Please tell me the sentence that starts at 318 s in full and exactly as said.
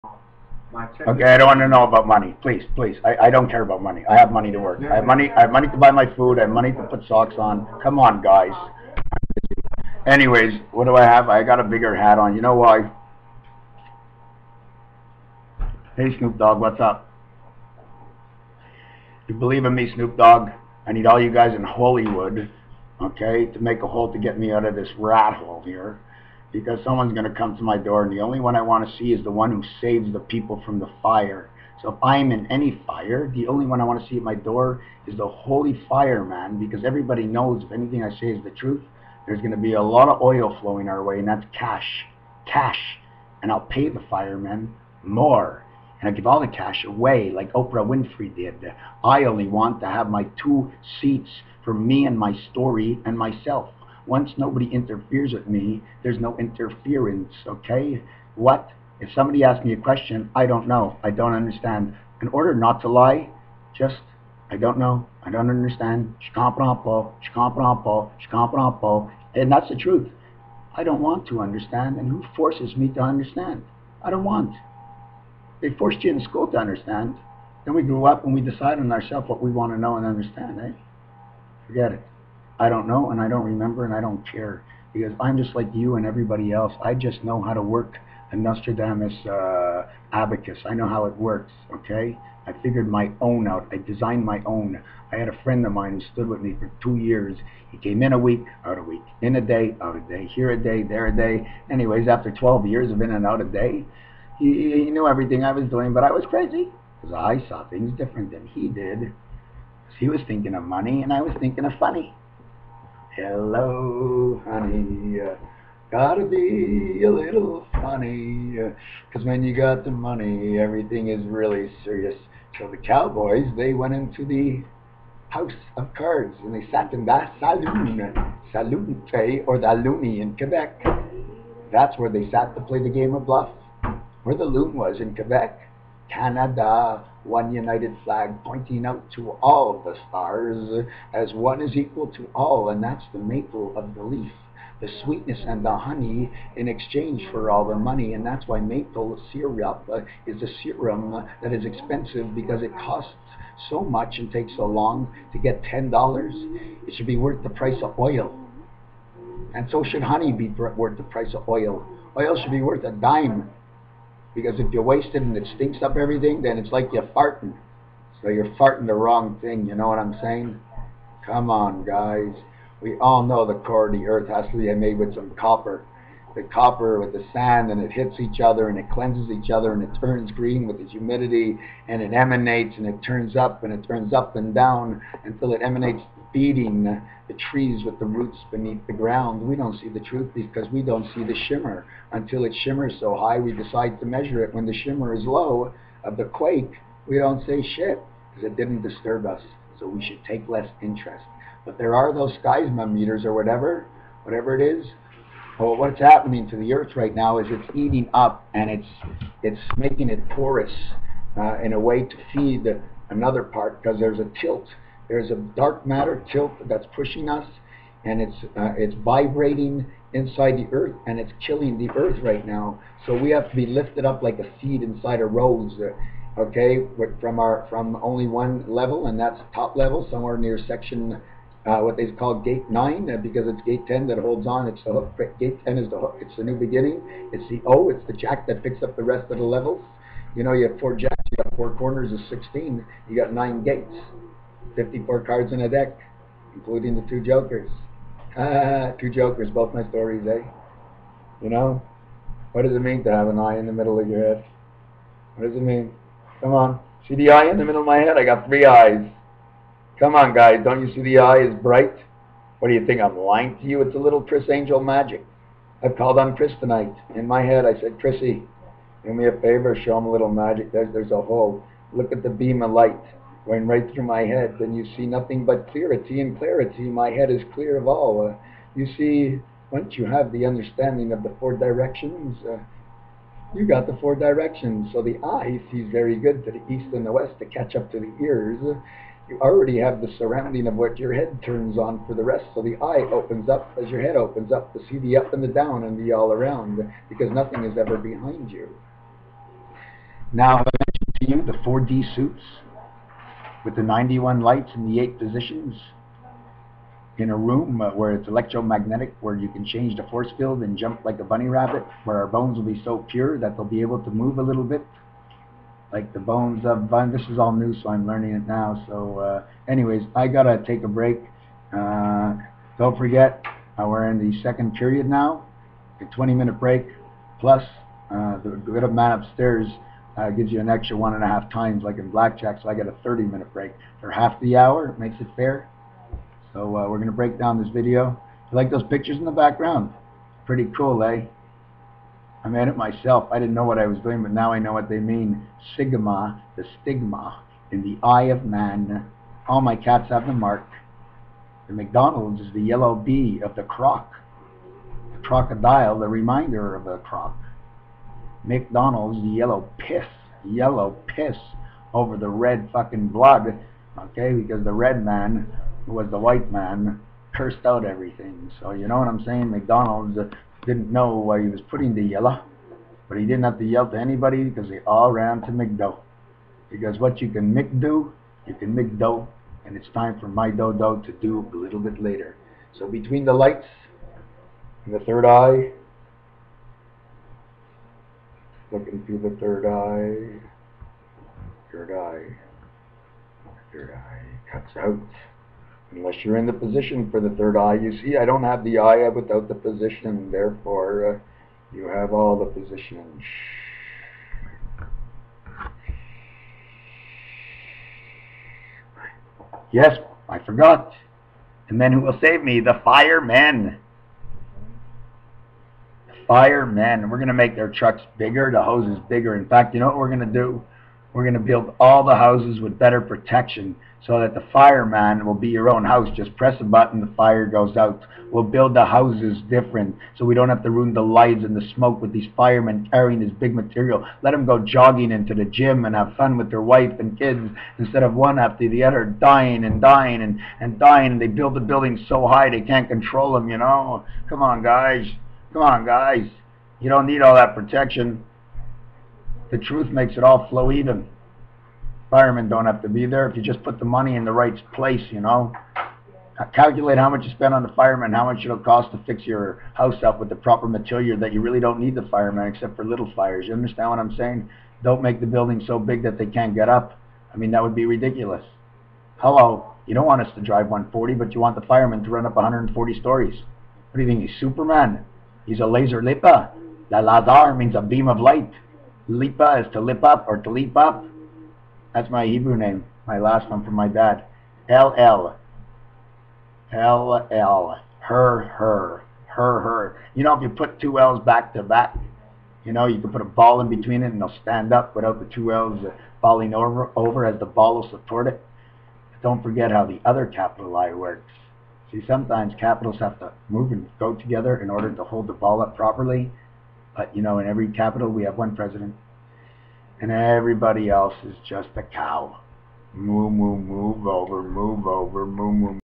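So, uh, anyways, I gotta take a break.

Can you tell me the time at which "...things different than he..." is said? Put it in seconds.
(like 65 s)
107 s.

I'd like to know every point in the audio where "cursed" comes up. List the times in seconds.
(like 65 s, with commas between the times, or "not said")
367 s.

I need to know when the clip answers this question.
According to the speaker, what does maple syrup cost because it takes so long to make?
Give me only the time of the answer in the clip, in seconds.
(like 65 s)
155 s.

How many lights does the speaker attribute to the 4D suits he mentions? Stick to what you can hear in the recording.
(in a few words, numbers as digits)
91.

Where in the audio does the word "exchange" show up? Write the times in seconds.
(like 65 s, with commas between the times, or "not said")
146 s.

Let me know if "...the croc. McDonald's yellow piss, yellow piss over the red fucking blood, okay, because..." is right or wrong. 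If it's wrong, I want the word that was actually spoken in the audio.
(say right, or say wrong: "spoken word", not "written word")
right.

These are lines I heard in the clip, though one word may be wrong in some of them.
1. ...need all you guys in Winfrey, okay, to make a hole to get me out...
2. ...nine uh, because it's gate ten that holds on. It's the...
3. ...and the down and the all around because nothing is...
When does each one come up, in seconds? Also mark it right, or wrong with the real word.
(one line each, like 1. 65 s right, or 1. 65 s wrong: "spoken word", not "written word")
1. 20 s wrong: "Hollywood", not "Winfrey"
2. 232 s right
3. 295 s right.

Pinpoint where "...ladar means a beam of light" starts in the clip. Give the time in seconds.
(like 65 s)
476 s.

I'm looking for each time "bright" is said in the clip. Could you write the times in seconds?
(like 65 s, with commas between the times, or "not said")
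261 s.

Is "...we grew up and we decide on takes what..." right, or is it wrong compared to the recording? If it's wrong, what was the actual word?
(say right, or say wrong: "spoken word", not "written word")
wrong: "ourselves", not "takes".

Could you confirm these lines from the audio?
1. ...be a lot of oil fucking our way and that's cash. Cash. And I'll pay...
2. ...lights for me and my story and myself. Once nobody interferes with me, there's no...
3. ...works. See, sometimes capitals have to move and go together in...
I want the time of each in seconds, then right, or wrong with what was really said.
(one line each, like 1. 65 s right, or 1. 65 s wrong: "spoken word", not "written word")
1. 39 s wrong: "flowing", not "fucking"
2. 50 s wrong: "seats", not "lights"
3. 500 s right.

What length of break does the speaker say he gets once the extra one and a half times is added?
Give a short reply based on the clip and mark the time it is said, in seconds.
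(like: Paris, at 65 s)
30 minutes, at 333 s.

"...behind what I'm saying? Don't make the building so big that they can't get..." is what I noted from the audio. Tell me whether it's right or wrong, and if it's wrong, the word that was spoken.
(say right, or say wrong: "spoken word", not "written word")
wrong: "understand", not "behind".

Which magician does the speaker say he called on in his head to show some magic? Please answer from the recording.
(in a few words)
Criss Angel.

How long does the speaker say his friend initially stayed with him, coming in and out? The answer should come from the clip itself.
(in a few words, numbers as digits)
2 years.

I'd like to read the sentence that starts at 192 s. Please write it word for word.
Until it shimmers so high, we decide to measure it.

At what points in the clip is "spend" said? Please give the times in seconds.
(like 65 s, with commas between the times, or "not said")
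457 s.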